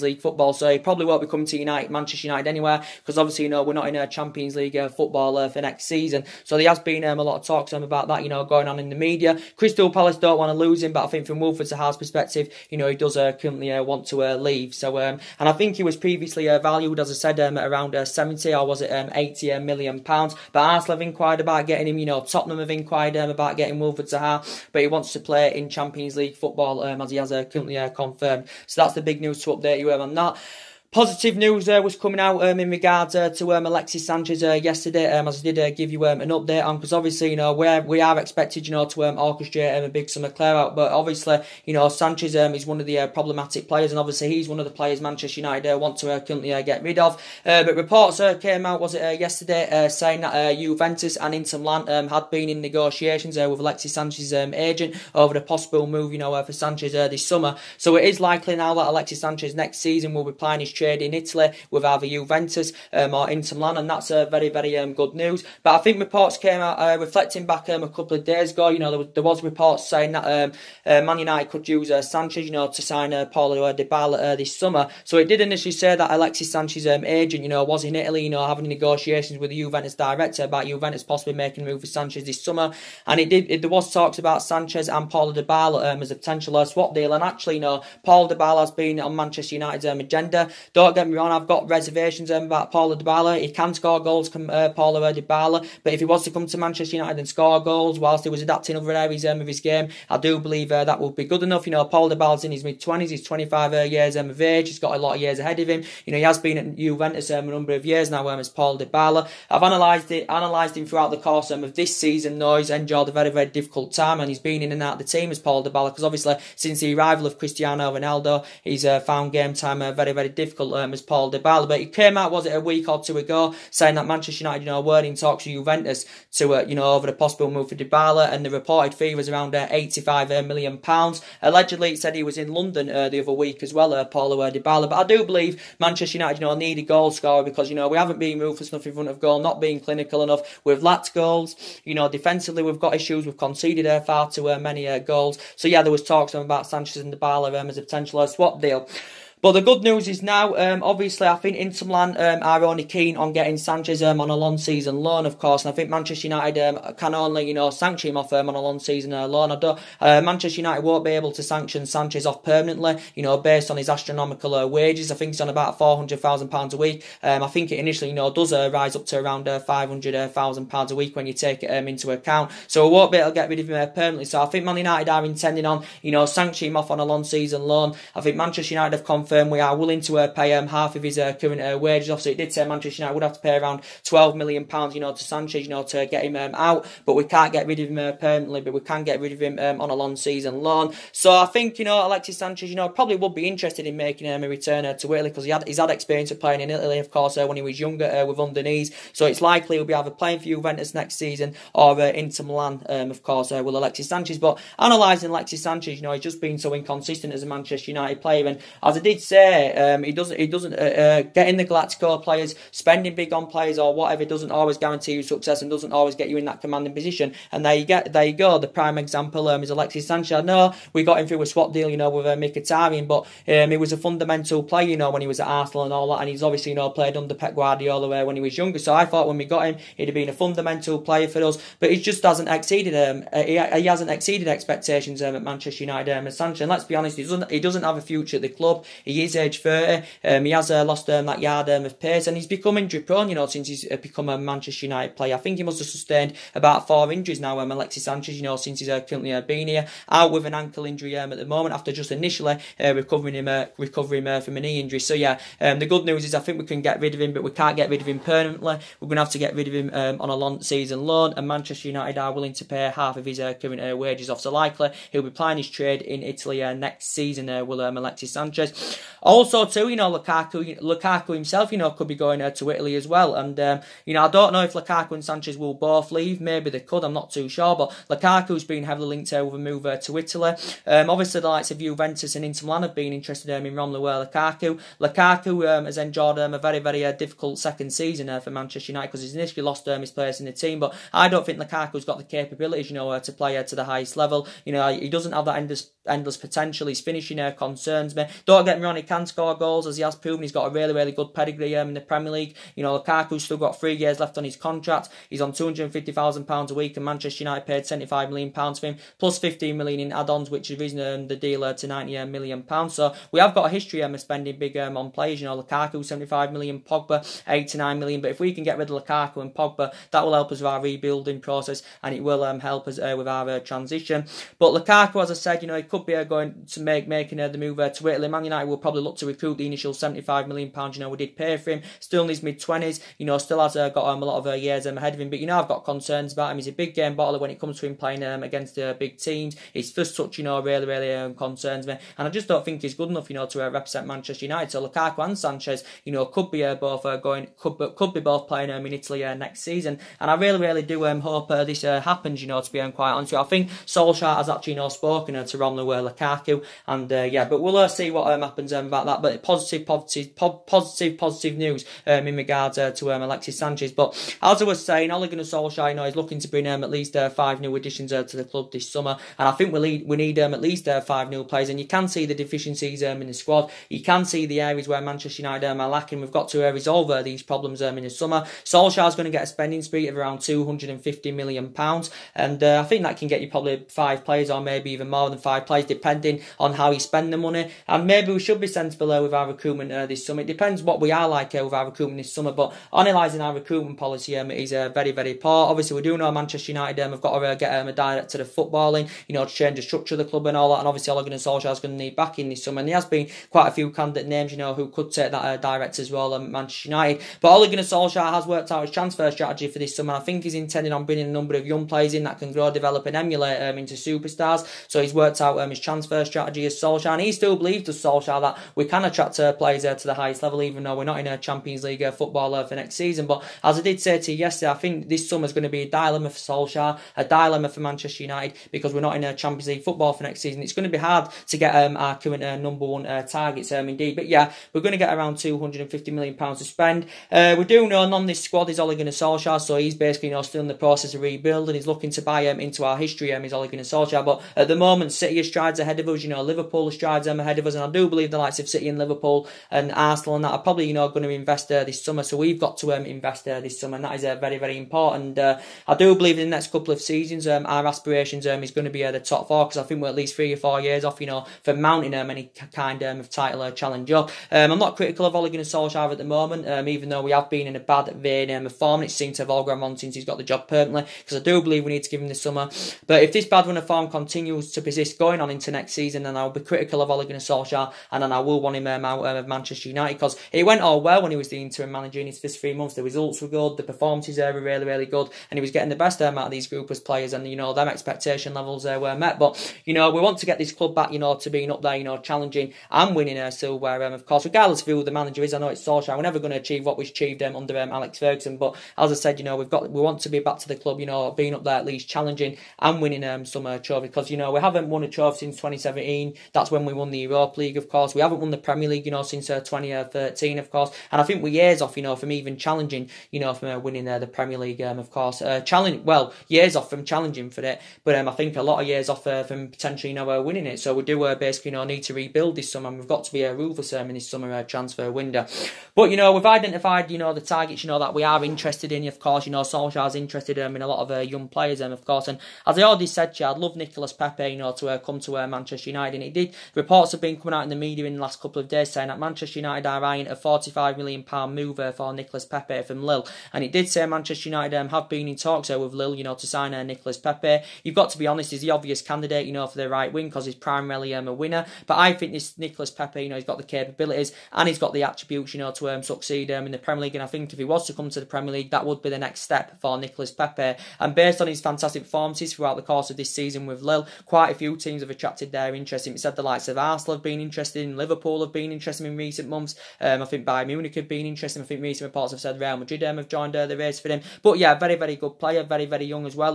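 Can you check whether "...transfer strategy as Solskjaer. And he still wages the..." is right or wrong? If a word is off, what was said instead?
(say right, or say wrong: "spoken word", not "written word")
wrong: "believes", not "wages".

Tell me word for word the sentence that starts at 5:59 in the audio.
But positive, positive, po- positive, positive news um, in regards uh, to um, Alexis Sanchez.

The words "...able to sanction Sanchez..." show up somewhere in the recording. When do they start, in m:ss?
2:41.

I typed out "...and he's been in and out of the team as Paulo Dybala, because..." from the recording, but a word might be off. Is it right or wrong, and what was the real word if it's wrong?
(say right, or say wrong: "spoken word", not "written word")
right.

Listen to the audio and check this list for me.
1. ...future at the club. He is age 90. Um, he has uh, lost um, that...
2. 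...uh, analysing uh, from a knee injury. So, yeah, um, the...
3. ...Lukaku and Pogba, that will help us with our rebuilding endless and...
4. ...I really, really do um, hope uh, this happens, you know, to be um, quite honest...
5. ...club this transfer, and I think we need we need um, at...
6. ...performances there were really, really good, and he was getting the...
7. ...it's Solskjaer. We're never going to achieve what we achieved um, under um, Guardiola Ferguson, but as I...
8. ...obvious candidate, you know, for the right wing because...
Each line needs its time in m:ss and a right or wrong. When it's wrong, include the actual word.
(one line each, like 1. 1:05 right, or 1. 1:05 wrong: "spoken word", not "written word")
1. 3:58 wrong: "30", not "90"
2. 4:13 wrong: "recovering", not "analysing"
3. 5:19 wrong: "process", not "endless"
4. 5:50 right
5. 6:08 wrong: "summer", not "transfer"
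6. 8:03 right
7. 8:15 wrong: "Alex", not "Guardiola"
8. 9:08 right.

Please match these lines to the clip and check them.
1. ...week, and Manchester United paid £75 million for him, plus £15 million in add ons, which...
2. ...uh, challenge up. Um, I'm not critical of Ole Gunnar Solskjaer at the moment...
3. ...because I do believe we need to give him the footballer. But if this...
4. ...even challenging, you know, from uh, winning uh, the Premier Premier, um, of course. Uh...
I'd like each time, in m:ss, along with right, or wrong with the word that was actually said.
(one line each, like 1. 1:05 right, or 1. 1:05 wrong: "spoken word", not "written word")
1. 5:06 right
2. 7:43 right
3. 7:51 wrong: "summer", not "footballer"
4. 8:32 wrong: "League", not "Premier".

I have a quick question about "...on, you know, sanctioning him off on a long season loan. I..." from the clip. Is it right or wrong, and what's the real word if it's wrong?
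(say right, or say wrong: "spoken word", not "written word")
right.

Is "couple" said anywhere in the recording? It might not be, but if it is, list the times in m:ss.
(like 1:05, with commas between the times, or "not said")
1:07, 7:36, 8:58.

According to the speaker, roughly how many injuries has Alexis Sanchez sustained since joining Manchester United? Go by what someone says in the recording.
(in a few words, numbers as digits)
4.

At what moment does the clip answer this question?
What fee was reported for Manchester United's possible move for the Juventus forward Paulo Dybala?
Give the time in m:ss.
2:09.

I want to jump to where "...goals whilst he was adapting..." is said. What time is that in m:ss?
1:37.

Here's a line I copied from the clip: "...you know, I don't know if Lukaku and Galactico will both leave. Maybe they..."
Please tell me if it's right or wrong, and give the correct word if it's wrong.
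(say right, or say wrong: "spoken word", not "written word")
wrong: "Sanchez", not "Galactico".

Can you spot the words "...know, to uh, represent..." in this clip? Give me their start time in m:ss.
5:43.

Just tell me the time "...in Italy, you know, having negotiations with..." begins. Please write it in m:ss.
1:17.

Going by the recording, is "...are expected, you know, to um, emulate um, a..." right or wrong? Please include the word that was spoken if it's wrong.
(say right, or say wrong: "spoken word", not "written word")
wrong: "orchestrate", not "emulate".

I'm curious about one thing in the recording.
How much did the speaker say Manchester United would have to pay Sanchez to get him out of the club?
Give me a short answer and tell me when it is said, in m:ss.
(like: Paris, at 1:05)
£12 million, at 3:04.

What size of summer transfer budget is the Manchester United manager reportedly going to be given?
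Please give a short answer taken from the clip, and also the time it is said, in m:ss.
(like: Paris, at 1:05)
£250 million, at 6:20.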